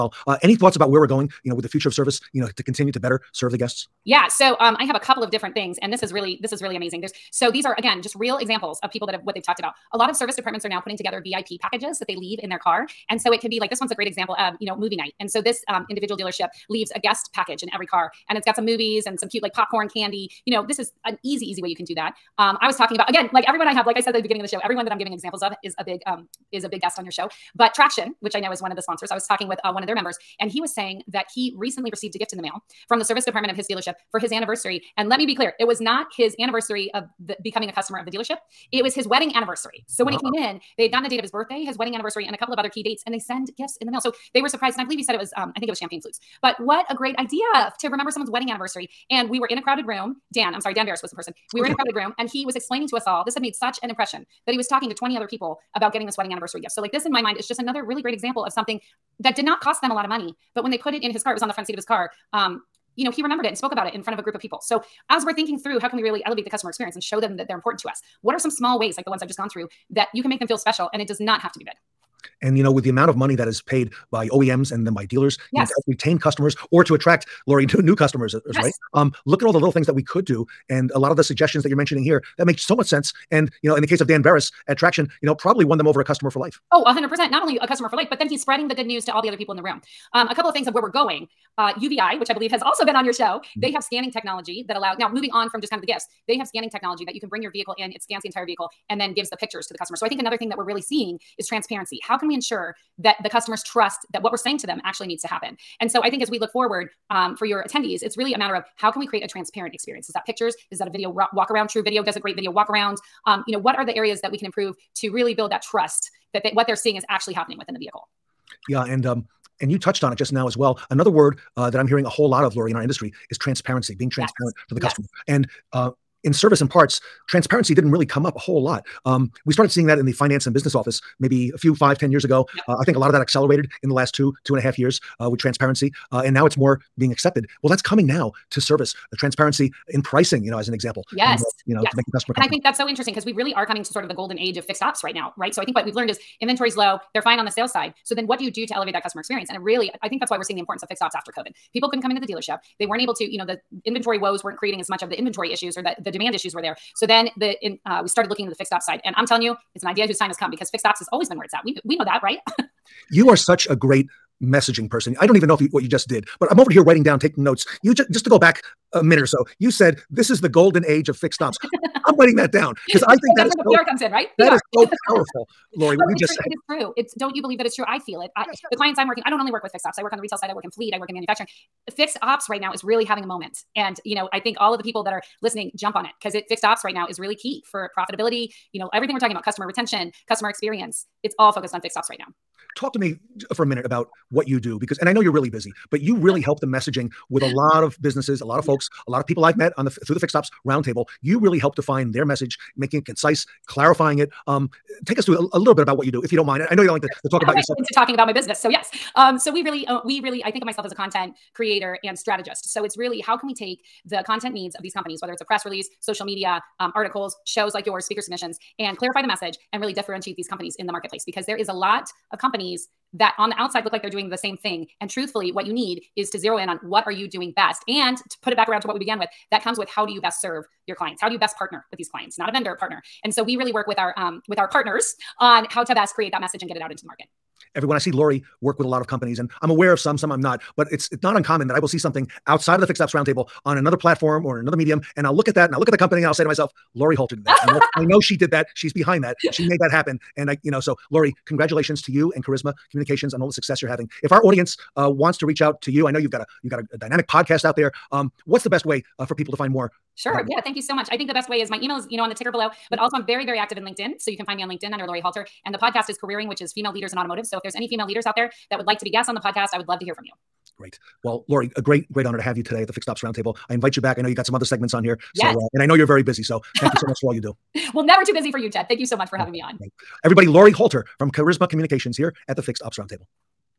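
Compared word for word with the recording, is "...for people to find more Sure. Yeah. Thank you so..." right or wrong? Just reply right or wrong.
right.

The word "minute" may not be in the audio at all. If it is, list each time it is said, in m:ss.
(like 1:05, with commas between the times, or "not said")
2:49, 3:13.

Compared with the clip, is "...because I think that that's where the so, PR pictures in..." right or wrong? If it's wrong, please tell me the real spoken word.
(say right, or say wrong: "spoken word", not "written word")
wrong: "comes", not "pictures".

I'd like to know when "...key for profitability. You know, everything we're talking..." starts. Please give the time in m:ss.
3:07.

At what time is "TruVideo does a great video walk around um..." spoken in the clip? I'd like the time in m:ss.
1:51.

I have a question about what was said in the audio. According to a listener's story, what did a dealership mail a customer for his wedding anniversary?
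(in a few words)
champagne flutes.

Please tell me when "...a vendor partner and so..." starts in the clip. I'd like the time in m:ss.
3:52.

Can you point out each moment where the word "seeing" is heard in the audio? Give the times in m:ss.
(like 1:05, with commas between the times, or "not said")
1:40, 1:56, 2:09, 2:30.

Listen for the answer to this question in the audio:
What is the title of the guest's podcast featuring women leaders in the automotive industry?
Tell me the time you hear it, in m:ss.
4:26.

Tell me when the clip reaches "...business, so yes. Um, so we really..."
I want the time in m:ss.
3:28.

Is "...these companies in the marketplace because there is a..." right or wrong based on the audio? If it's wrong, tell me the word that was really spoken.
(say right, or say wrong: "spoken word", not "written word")
right.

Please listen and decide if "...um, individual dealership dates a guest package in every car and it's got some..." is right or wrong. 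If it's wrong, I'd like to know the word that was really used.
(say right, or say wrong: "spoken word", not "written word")
wrong: "leaves", not "dates".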